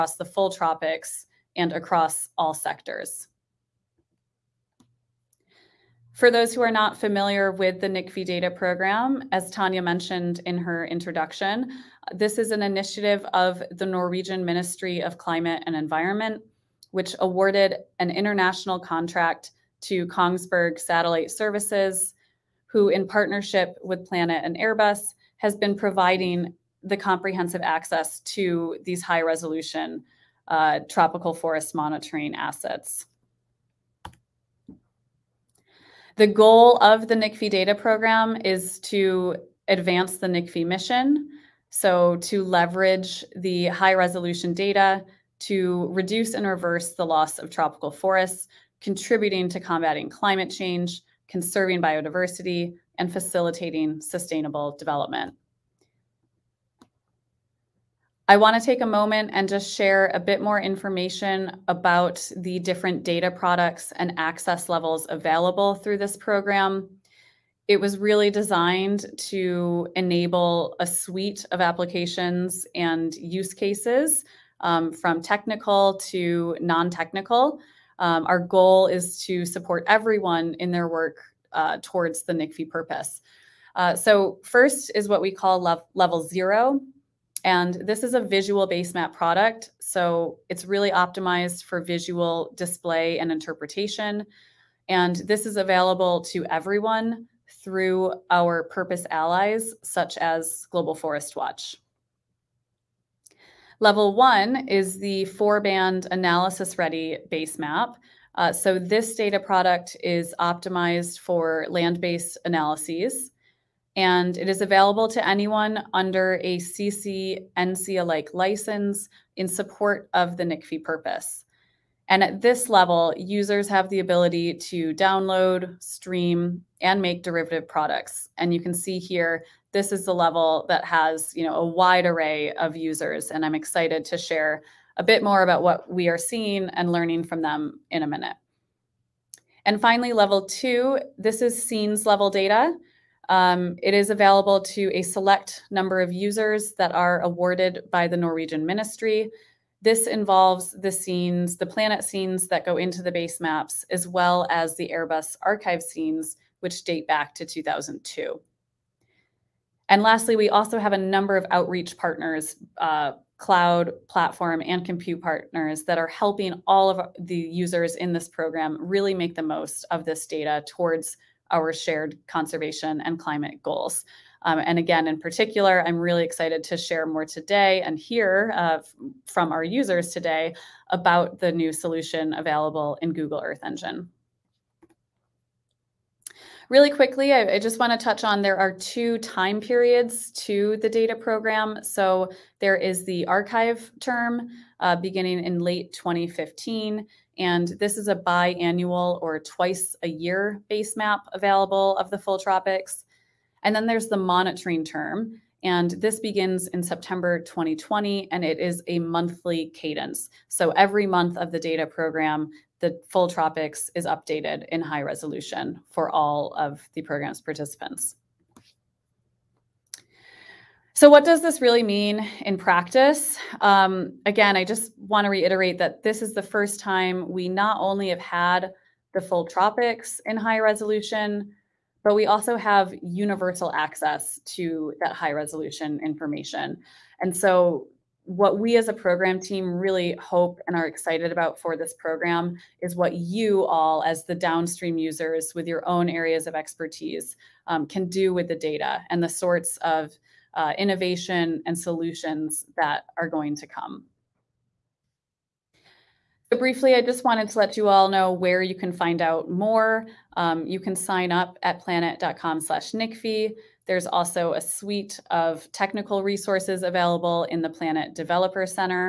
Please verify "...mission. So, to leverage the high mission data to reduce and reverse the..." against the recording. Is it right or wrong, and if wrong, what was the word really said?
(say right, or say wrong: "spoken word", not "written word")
wrong: "resolution", not "mission".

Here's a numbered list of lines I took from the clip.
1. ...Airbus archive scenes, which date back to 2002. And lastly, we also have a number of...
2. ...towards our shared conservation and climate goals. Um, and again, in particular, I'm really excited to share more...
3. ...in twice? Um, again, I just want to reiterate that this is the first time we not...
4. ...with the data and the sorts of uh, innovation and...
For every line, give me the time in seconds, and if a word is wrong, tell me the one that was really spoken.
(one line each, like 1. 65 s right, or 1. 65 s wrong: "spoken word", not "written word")
1. 154 s right
2. 170 s right
3. 222 s wrong: "practice", not "twice"
4. 248 s right.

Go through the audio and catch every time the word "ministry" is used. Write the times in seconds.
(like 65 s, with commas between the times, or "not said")
14 s, 148 s.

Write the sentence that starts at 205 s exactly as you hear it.
And this begins in September 2020, and it is a monthly cadence.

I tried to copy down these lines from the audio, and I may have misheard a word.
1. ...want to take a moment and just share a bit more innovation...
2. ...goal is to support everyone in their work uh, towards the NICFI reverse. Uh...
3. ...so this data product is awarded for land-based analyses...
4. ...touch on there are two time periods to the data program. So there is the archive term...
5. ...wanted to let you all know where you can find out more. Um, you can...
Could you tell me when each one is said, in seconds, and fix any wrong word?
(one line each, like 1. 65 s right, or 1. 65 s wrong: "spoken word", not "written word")
1. 58 s wrong: "information", not "innovation"
2. 78 s wrong: "purpose", not "reverse"
3. 108 s wrong: "optimized", not "awarded"
4. 188 s right
5. 257 s right.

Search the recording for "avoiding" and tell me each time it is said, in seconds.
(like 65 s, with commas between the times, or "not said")
not said.